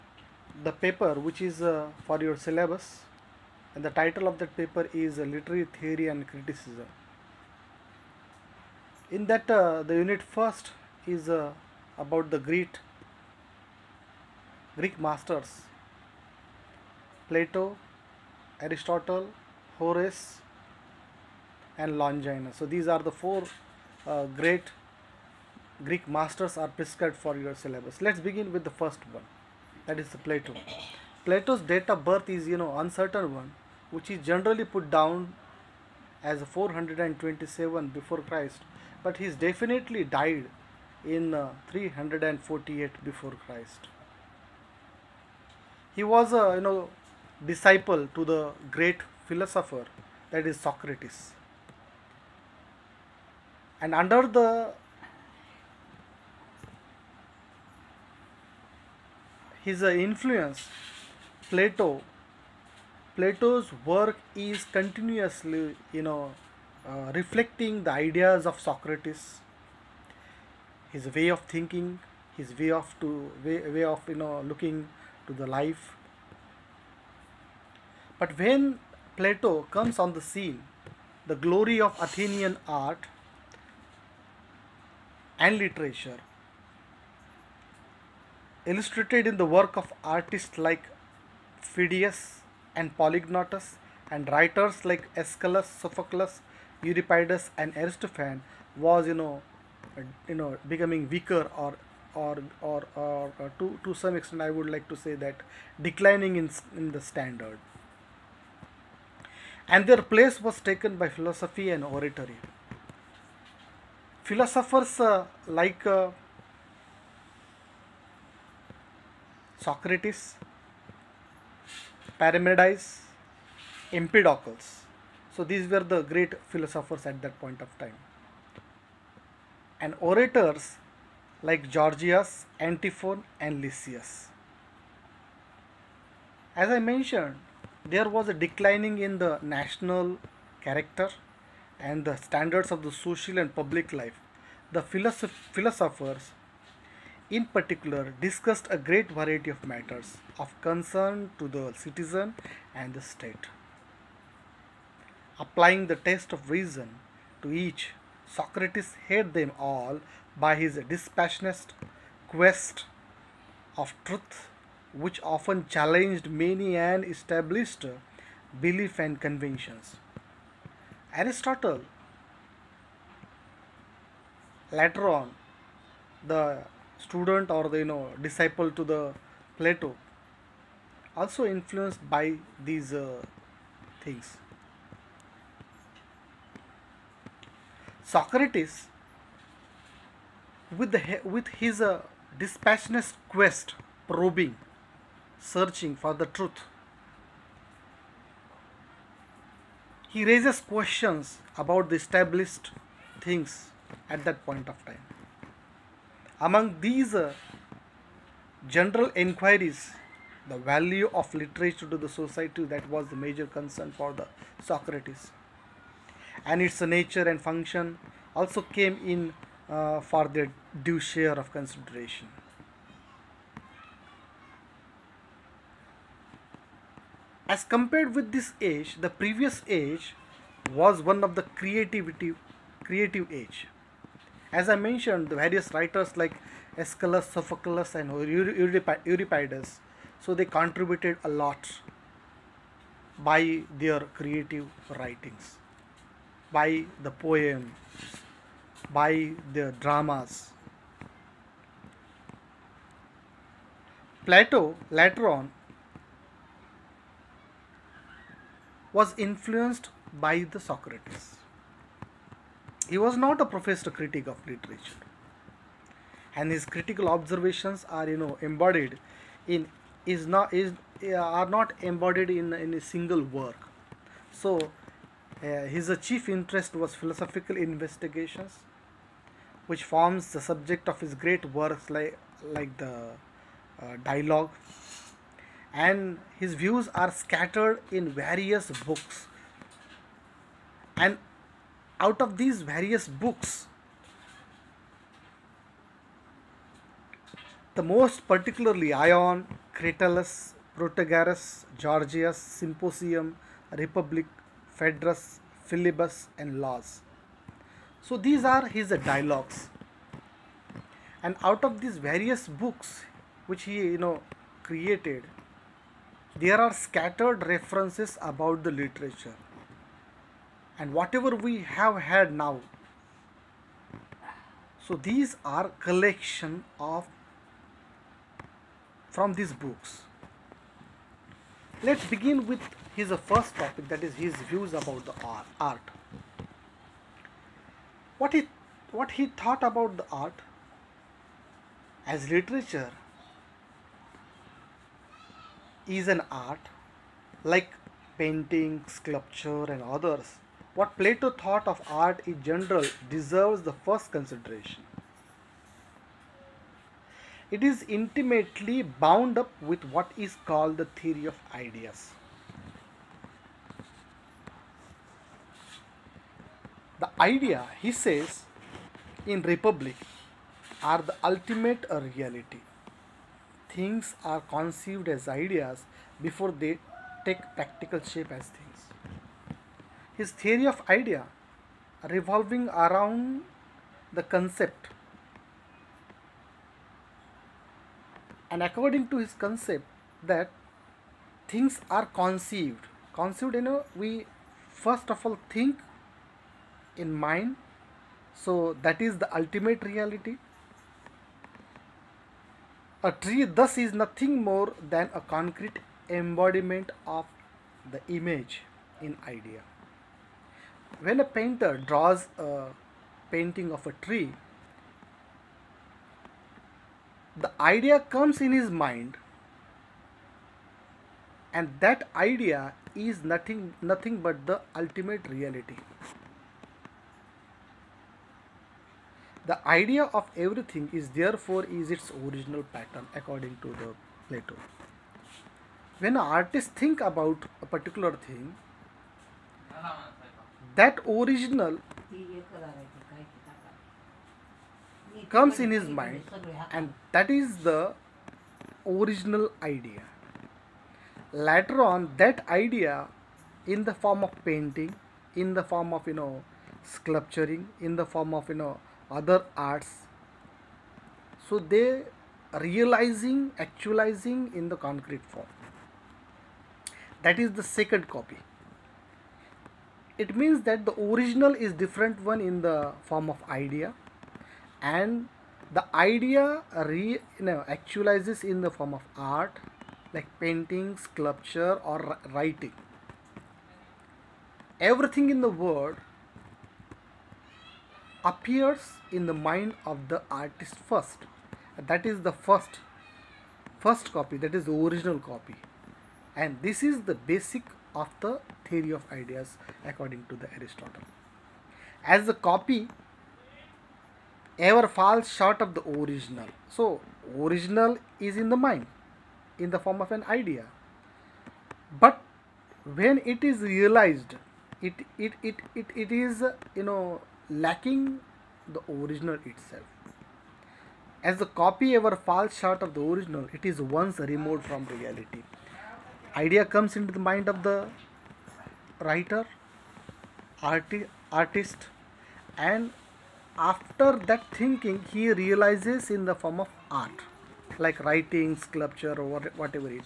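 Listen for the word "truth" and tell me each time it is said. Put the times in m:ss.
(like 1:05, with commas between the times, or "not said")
2:44, 3:16.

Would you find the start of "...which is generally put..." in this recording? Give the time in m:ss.
0:33.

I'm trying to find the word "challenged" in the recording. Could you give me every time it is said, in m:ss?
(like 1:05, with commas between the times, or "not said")
2:45.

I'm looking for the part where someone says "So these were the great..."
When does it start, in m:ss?
2:05.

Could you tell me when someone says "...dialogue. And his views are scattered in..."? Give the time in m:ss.
4:44.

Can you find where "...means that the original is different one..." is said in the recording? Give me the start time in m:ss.
7:50.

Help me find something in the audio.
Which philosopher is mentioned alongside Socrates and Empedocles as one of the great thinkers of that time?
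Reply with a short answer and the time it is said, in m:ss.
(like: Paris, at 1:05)
Parmenides, at 2:02.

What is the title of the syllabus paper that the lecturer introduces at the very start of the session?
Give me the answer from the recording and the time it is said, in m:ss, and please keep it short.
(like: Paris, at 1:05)
Literary Theory and Criticism, at 0:05.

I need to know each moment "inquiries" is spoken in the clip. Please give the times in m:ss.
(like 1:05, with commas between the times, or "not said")
3:29.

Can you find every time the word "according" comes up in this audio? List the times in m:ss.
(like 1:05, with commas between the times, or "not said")
6:28, 7:13, 8:19.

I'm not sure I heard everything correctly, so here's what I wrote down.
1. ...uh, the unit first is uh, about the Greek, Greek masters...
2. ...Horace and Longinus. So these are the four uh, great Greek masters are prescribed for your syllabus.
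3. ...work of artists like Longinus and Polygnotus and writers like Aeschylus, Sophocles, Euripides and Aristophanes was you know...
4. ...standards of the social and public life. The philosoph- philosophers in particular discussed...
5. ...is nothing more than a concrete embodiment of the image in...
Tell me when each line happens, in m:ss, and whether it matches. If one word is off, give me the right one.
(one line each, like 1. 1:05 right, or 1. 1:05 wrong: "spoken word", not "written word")
1. 0:09 right
2. 0:19 right
3. 1:29 wrong: "Phidias", not "Longinus"
4. 2:22 right
5. 6:43 right.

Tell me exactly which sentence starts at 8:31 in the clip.
But when it is realized, it it, it, it, it is you know lacking the original itself.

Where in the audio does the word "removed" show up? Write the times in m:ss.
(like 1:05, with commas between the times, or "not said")
8:44.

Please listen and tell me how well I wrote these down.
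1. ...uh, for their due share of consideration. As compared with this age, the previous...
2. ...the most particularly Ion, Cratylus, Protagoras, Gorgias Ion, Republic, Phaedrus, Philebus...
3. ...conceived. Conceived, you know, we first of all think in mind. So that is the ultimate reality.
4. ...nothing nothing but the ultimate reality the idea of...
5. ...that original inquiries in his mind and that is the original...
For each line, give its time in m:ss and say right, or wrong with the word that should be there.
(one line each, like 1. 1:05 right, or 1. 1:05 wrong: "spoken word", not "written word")
1. 3:39 right
2. 4:57 wrong: "Symposium", not "Ion"
3. 6:32 right
4. 7:03 right
5. 7:20 wrong: "comes", not "inquiries".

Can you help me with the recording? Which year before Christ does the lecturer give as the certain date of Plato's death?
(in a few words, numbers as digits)
348 BC.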